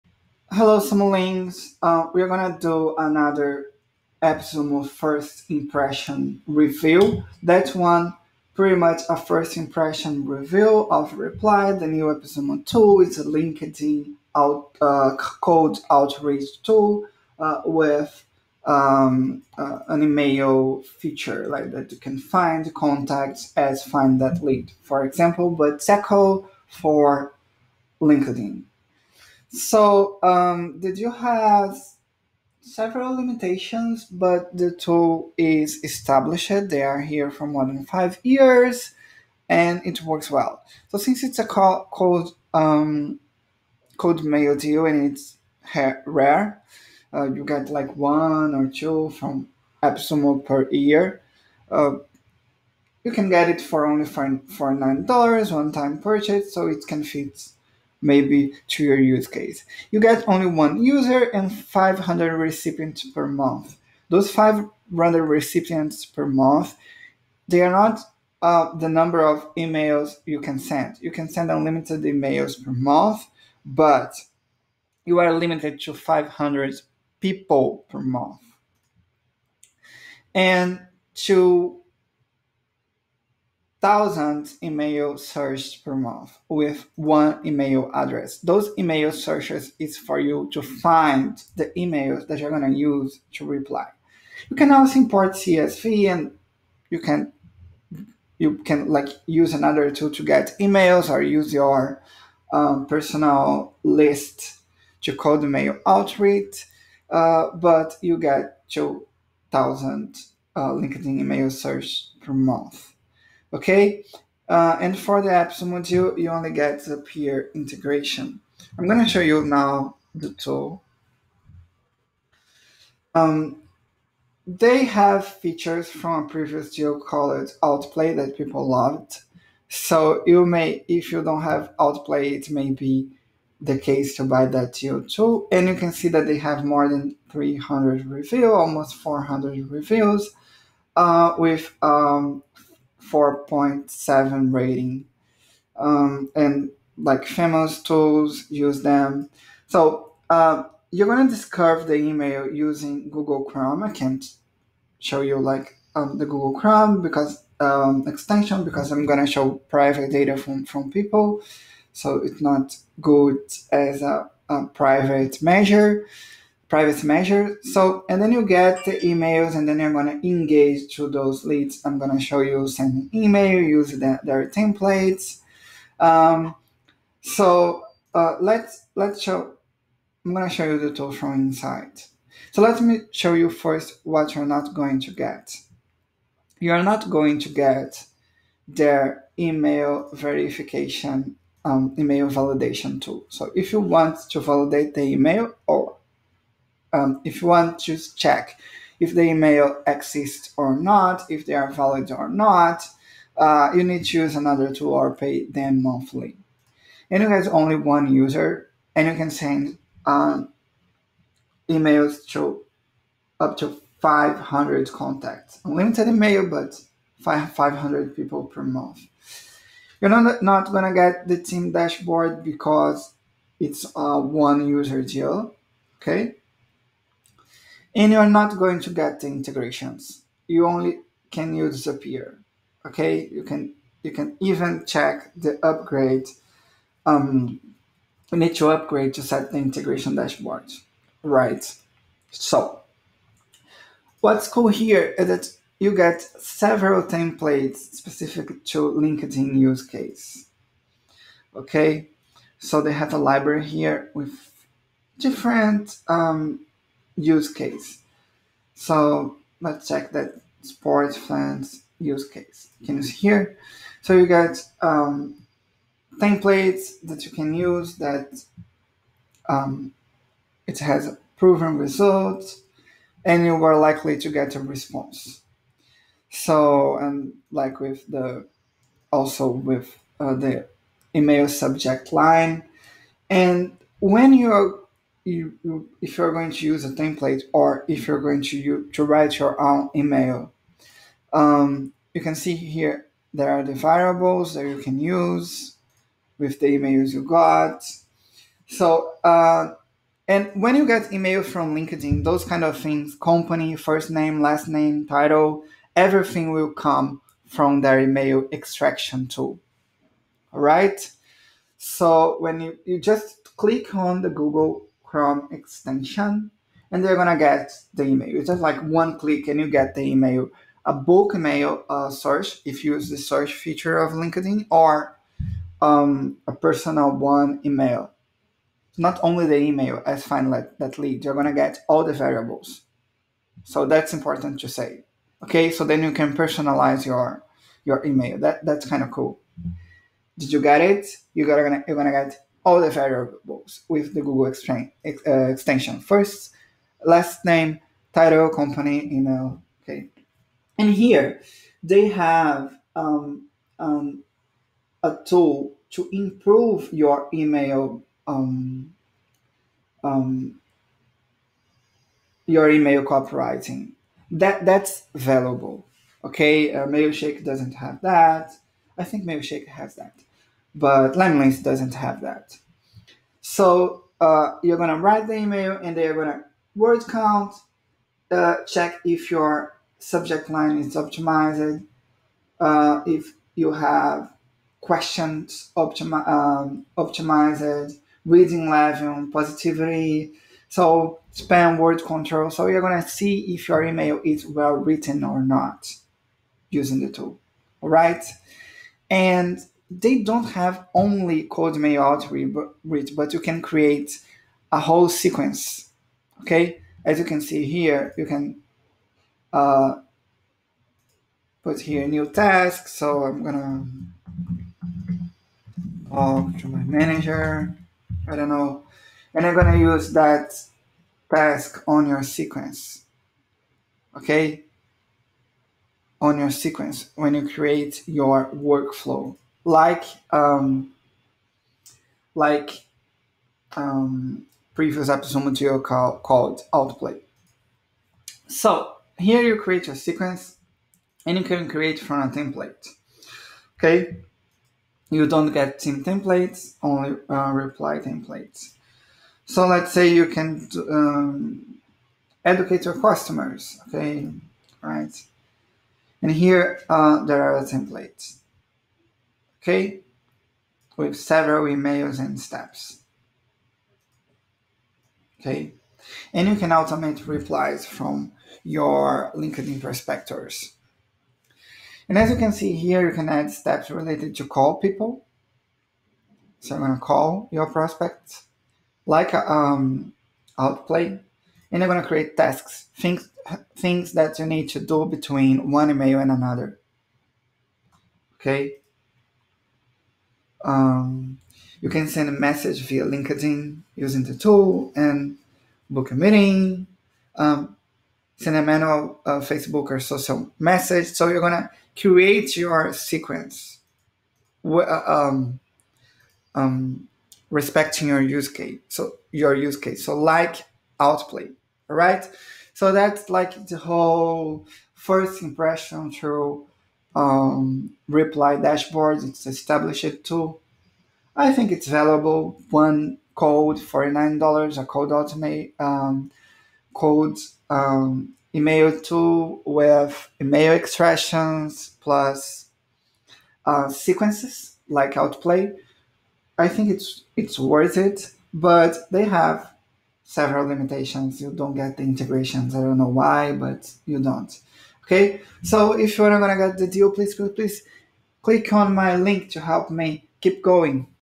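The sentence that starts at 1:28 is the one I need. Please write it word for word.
Those email searches is for you to find the emails that you're going to use to reply.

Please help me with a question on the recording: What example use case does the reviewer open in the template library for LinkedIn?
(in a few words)
Sports fans.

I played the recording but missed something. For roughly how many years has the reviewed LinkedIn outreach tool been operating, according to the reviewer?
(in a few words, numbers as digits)
5 years.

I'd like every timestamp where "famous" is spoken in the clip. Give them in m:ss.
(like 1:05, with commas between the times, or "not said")
2:27.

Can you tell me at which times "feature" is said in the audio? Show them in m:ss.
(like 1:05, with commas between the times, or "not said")
0:20, 2:05, 5:23.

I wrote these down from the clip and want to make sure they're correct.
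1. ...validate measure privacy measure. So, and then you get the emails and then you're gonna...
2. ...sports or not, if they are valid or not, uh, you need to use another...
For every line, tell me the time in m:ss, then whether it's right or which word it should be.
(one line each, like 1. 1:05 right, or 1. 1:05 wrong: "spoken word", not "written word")
1. 2:44 wrong: "private", not "validate"
2. 3:19 wrong: "exists", not "sports".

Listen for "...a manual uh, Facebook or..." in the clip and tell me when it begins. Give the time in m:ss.
8:18.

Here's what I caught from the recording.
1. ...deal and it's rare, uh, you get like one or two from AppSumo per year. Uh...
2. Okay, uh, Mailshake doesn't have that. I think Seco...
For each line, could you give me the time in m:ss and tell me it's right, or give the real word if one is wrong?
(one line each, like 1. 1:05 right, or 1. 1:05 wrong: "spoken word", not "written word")
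1. 0:44 right
2. 6:06 wrong: "Mailshake", not "Seco".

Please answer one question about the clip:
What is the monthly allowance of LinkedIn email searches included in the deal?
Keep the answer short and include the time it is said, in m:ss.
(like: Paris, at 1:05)
2,000, at 1:48.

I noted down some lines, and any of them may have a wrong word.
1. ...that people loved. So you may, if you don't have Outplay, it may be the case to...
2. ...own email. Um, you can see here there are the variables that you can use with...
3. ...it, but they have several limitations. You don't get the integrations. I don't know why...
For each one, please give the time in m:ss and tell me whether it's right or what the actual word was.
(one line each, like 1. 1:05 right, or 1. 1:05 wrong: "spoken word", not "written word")
1. 2:08 right
2. 4:49 right
3. 8:57 right.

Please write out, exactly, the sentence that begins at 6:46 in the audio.
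Okay, as you can see here, you can uh, put here new task.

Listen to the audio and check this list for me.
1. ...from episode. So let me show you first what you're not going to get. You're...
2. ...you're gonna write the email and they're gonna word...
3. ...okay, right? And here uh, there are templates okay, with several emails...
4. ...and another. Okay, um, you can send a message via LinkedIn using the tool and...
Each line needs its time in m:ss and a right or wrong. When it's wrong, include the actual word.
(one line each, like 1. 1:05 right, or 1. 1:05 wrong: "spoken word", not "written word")
1. 3:01 wrong: "inside", not "episode"
2. 6:14 right
3. 7:33 right
4. 8:06 right.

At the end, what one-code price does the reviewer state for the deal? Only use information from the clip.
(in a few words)
$49.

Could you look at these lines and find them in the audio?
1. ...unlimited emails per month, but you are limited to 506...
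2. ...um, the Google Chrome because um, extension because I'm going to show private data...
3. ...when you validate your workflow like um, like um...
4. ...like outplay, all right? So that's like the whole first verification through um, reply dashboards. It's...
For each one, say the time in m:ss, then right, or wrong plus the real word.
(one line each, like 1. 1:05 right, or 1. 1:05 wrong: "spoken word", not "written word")
1. 1:11 wrong: "500", not "506"
2. 2:35 right
3. 7:07 wrong: "create", not "validate"
4. 8:30 wrong: "impression", not "verification".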